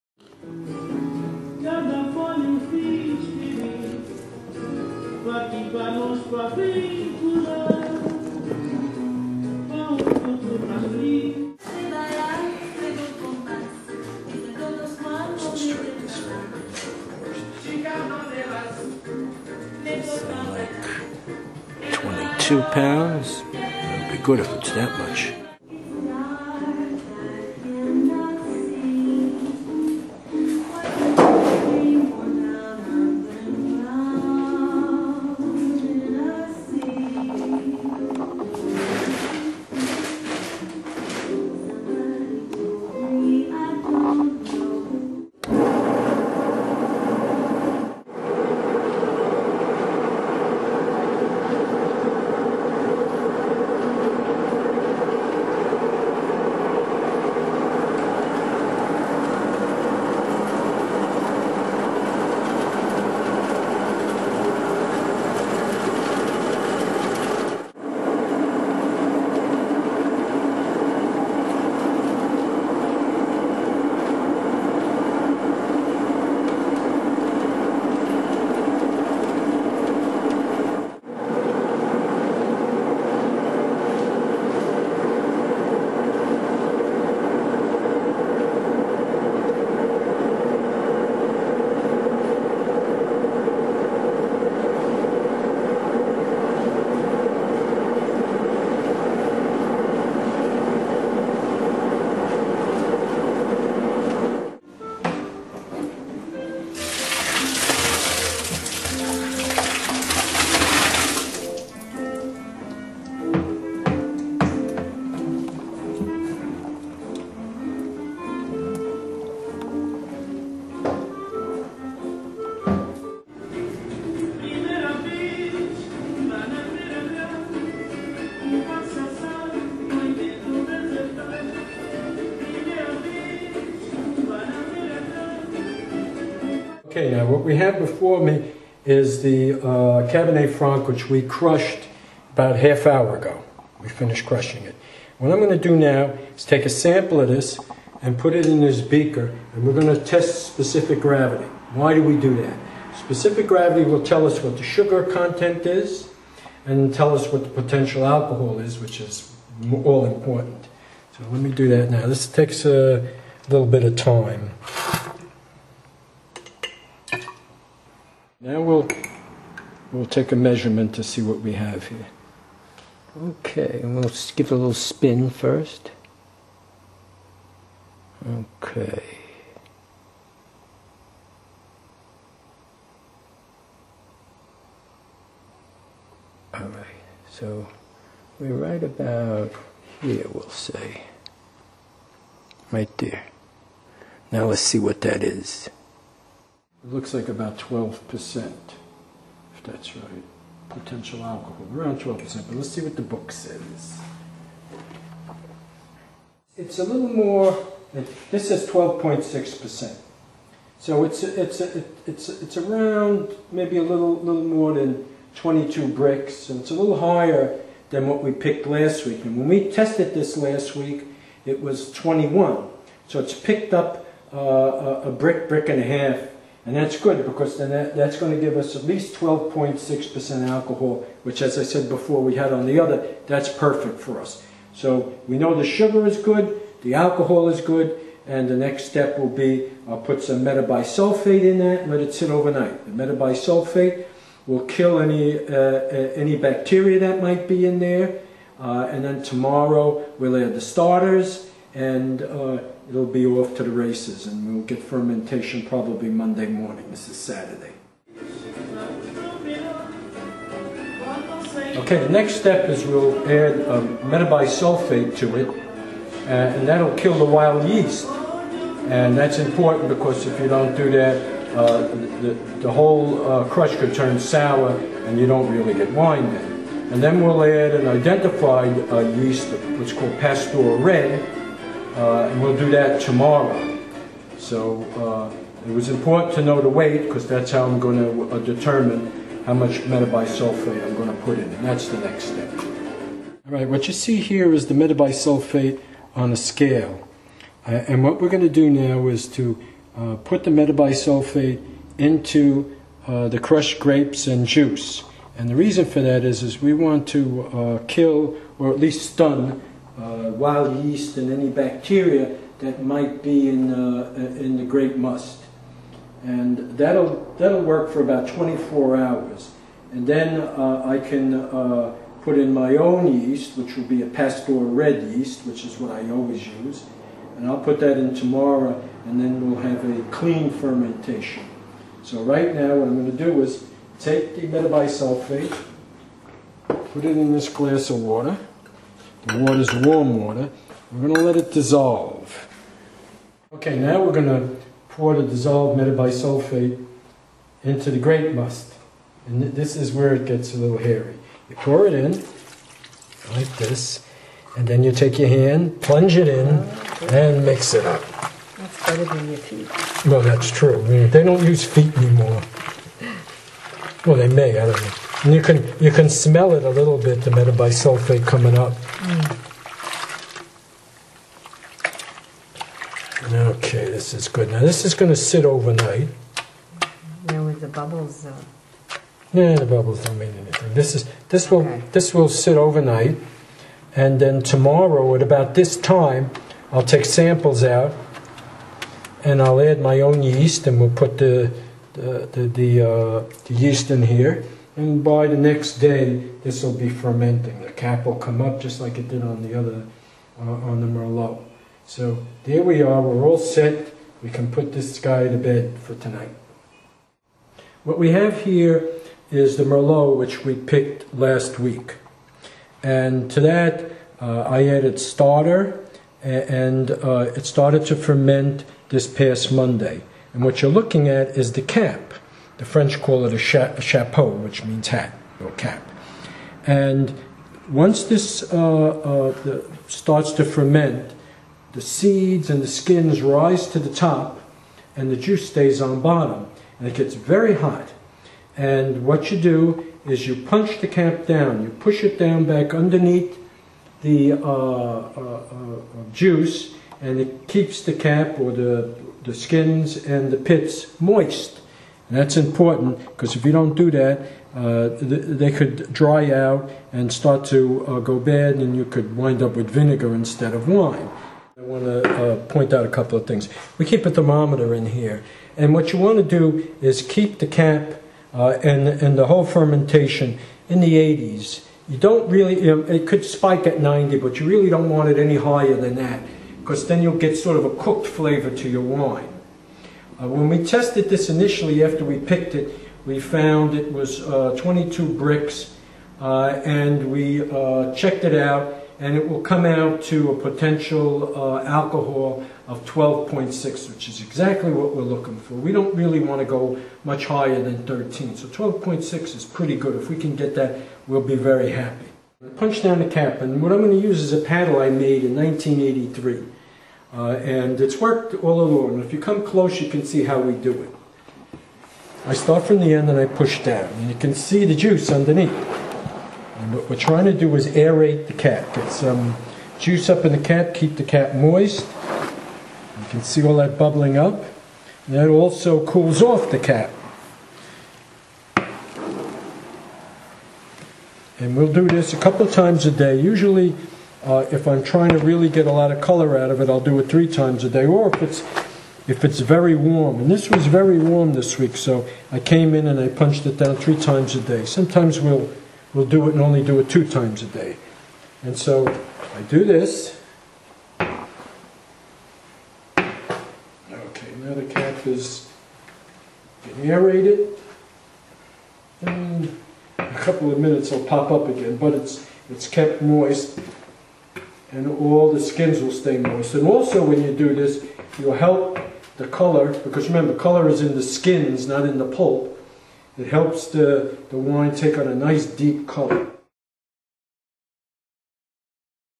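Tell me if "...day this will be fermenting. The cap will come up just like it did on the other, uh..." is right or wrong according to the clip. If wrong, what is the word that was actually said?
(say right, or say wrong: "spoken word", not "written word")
right.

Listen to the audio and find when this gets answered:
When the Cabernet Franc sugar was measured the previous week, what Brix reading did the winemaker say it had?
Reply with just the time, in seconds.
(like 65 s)
221 s.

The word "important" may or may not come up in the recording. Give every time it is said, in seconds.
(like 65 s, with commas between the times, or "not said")
160 s, 269 s, 285 s, 452 s.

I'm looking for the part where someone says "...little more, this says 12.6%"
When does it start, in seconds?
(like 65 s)
206 s.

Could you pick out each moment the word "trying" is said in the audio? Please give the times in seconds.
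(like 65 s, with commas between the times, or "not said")
516 s, 534 s.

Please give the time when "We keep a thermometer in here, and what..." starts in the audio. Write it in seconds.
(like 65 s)
463 s.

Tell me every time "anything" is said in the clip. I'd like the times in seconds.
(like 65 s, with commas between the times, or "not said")
380 s.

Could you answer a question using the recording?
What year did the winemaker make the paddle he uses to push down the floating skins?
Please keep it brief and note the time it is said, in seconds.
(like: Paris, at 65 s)
1983, at 505 s.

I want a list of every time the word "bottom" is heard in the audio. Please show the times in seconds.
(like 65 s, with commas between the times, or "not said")
436 s.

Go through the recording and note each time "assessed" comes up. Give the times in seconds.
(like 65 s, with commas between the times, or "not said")
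not said.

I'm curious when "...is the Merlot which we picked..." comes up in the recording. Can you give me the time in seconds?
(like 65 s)
409 s.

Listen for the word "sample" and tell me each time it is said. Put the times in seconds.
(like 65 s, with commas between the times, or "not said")
146 s, 387 s.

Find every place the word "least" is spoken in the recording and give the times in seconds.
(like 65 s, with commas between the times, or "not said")
228 s, 308 s.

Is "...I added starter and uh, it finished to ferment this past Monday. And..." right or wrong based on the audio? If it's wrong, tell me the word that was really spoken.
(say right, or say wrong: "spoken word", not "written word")
wrong: "started", not "finished".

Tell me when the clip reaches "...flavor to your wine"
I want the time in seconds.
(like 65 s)
478 s.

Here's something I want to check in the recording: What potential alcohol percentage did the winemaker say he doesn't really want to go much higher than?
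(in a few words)
13.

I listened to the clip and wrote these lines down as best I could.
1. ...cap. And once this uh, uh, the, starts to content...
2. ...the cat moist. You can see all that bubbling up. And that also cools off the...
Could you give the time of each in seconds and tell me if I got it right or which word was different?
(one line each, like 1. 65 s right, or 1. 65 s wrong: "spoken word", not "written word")
1. 425 s wrong: "ferment", not "content"
2. 520 s right.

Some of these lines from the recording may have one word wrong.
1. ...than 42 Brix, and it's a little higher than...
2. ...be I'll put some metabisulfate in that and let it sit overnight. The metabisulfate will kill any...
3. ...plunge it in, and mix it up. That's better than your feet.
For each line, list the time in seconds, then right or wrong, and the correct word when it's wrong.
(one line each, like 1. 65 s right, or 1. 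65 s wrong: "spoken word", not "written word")
1. 214 s wrong: "22", not "42"
2. 239 s right
3. 355 s right.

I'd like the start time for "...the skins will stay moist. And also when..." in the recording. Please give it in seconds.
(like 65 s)
565 s.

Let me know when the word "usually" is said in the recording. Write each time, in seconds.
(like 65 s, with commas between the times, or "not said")
533 s.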